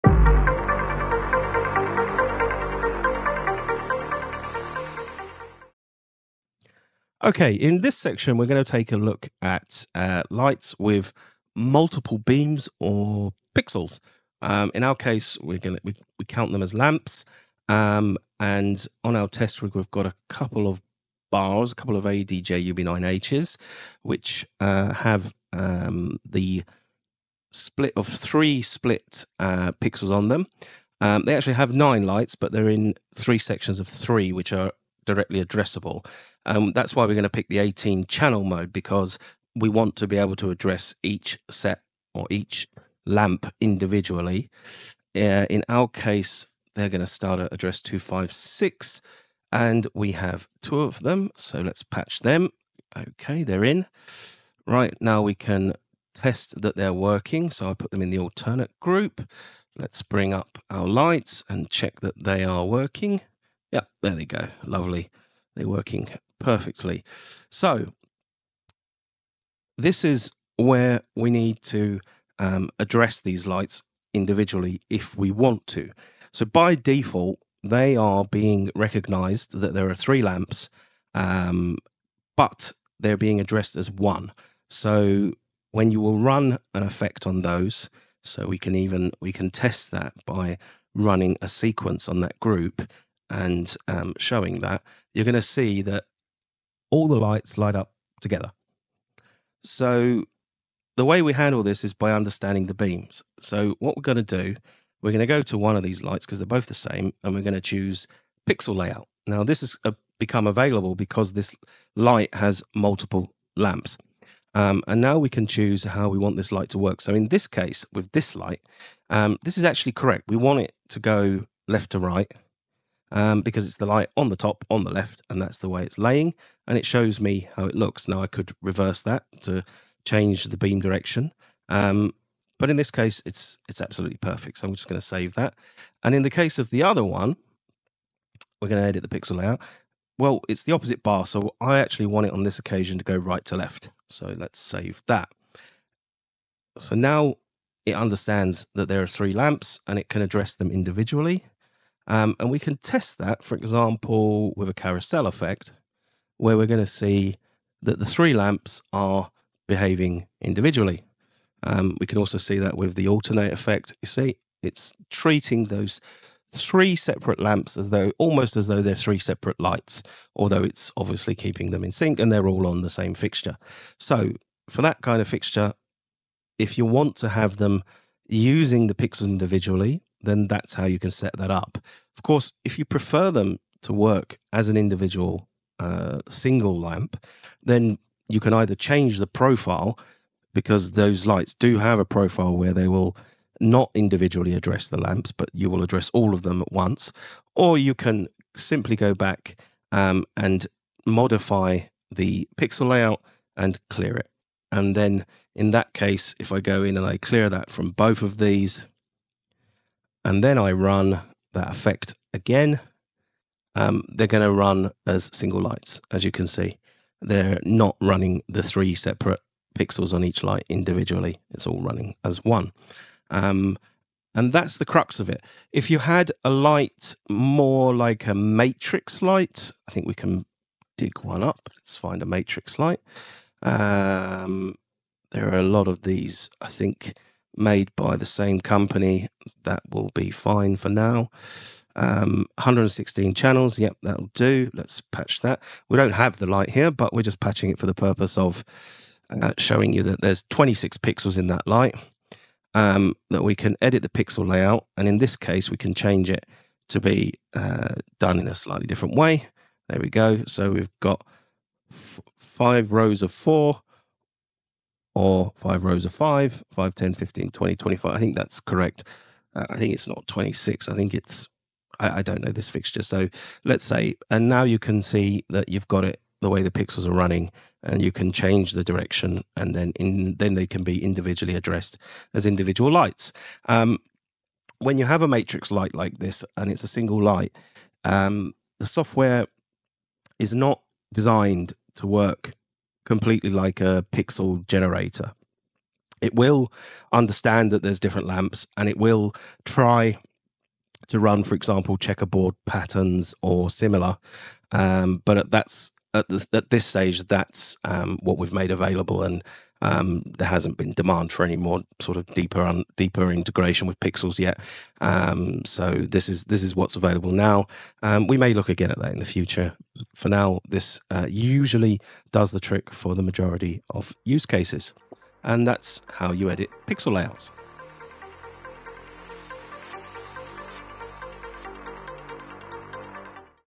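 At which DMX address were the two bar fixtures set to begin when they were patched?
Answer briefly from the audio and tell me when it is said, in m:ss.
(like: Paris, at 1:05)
256, at 0:47.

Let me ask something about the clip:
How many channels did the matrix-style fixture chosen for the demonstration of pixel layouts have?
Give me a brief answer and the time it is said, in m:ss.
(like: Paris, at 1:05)
116, at 4:02.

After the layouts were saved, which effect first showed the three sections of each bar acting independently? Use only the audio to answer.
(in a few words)
Carousel effect.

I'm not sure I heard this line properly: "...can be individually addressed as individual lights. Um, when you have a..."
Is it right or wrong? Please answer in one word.
right.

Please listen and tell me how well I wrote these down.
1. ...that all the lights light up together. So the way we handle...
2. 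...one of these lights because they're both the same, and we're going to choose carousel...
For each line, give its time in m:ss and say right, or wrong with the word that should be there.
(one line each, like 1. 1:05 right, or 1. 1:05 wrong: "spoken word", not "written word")
1. 1:35 right
2. 1:45 wrong: "pixel", not "carousel".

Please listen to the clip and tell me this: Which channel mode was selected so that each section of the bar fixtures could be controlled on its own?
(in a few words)
18 channel mode.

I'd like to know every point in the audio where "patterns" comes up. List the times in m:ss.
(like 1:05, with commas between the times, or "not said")
5:02.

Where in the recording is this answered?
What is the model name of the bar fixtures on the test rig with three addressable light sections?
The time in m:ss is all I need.
0:22.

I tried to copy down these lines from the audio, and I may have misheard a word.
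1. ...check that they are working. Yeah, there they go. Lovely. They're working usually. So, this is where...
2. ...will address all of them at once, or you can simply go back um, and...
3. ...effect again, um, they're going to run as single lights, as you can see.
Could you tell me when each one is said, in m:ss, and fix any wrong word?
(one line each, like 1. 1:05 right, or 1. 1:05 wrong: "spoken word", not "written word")
1. 1:01 wrong: "perfectly", not "usually"
2. 3:15 right
3. 3:31 right.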